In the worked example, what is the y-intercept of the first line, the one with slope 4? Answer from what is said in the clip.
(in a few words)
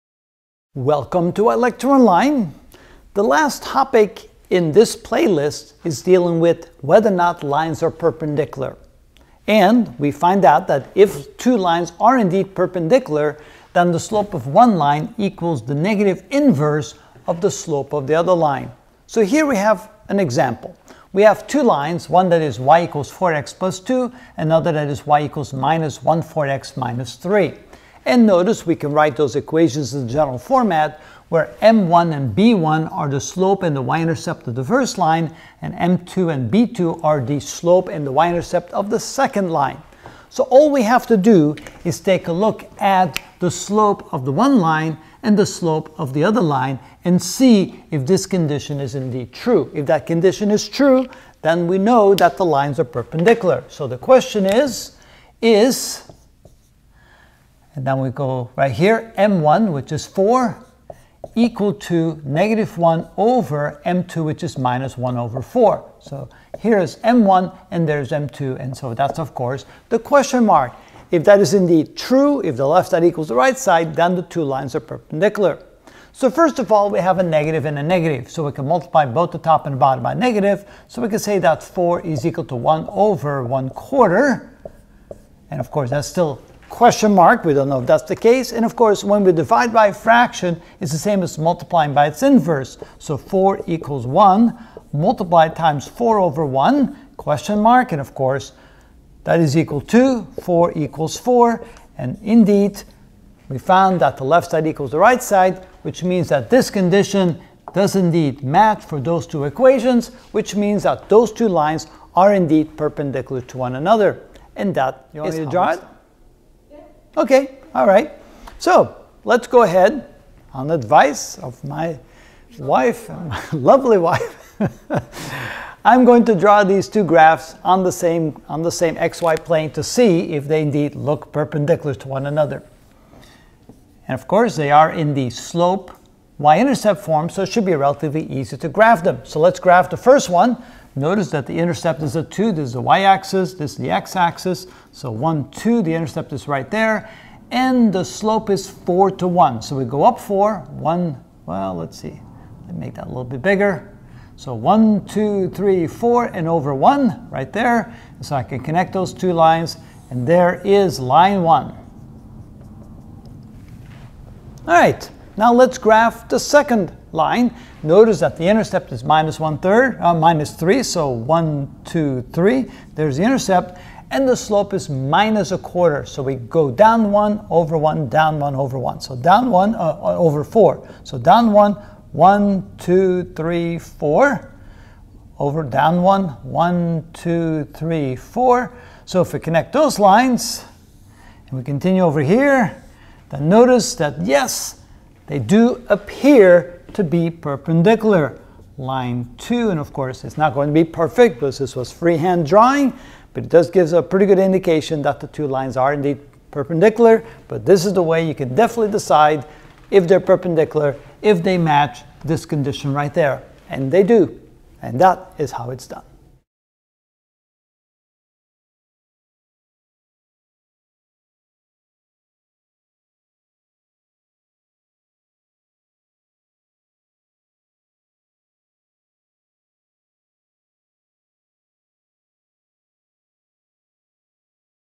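2.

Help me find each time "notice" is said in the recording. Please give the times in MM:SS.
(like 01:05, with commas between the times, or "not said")
00:28, 02:20, 02:47, 03:13.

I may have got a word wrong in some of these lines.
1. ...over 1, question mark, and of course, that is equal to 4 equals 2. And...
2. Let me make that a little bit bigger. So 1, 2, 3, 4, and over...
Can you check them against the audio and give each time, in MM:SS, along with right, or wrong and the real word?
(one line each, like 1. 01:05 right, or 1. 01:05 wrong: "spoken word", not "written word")
1. 01:36 wrong: "4", not "2"
2. 02:32 right.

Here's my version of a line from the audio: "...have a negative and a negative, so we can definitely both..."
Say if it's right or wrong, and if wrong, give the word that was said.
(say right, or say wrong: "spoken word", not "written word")
wrong: "multiply", not "definitely".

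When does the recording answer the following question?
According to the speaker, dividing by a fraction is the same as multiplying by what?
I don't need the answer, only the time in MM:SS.
01:32.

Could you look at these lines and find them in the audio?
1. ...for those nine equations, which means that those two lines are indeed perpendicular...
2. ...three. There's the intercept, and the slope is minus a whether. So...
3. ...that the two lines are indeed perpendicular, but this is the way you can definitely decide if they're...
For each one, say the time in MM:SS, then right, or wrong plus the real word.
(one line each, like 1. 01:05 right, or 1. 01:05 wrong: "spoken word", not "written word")
1. 01:48 wrong: "two", not "nine"
2. 02:52 wrong: "quarter", not "whether"
3. 03:25 right.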